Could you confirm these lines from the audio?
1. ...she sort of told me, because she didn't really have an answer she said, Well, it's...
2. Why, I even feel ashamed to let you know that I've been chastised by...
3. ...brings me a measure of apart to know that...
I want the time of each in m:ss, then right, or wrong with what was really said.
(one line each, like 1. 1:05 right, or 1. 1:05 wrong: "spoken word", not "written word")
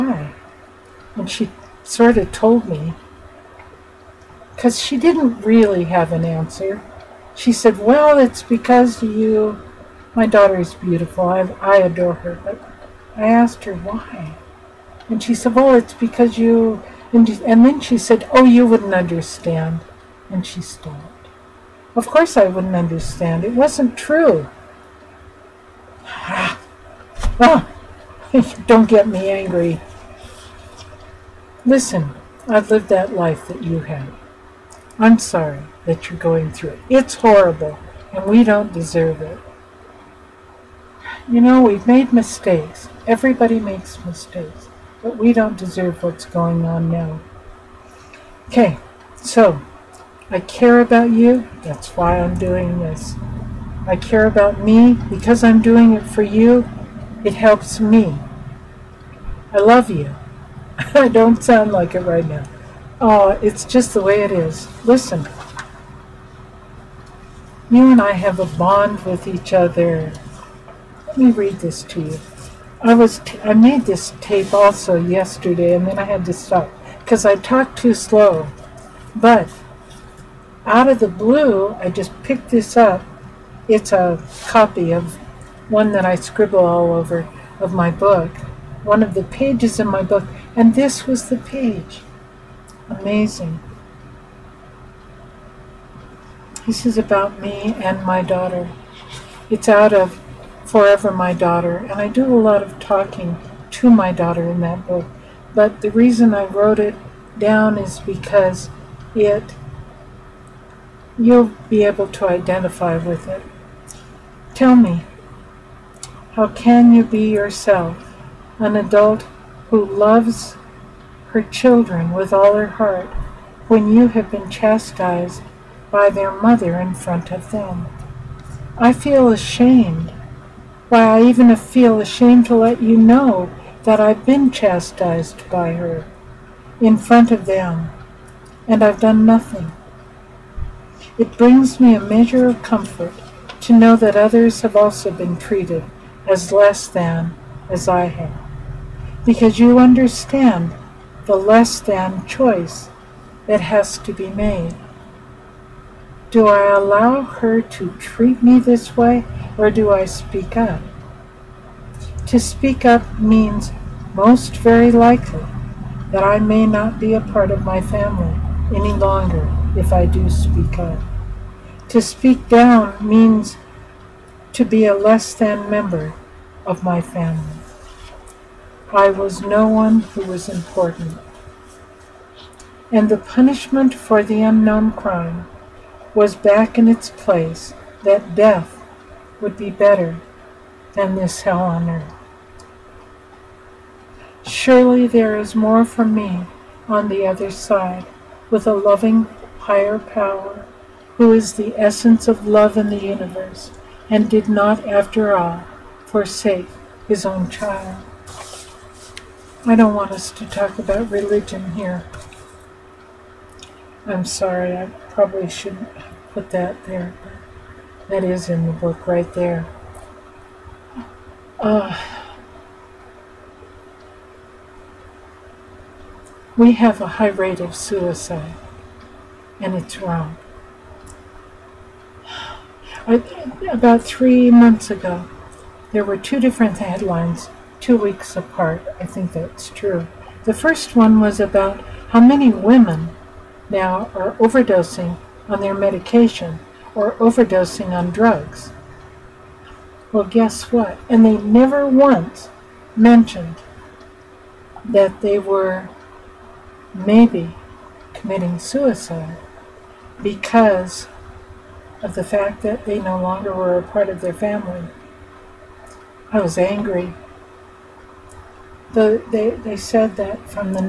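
1. 0:01 right
2. 2:10 right
3. 2:21 wrong: "comfort", not "apart".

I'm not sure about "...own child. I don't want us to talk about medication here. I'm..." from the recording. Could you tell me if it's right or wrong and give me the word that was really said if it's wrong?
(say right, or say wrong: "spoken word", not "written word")
wrong: "religion", not "medication".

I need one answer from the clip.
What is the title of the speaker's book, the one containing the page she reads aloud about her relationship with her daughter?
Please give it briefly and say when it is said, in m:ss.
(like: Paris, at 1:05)
Forever My Daughter, at 1:40.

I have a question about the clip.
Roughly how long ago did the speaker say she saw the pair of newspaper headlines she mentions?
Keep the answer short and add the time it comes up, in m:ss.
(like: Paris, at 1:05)
About 3 months ago, at 3:53.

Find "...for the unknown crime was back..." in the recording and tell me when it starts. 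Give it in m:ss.
3:03.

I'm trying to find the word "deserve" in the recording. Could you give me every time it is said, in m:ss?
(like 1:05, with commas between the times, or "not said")
0:38, 0:45.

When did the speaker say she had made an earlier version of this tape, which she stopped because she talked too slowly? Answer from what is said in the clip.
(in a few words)
Yesterday.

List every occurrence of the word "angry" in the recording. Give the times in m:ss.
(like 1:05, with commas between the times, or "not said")
0:29, 4:26.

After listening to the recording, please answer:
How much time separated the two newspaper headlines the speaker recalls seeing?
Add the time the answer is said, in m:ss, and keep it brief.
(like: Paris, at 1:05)
2 weeks, at 3:57.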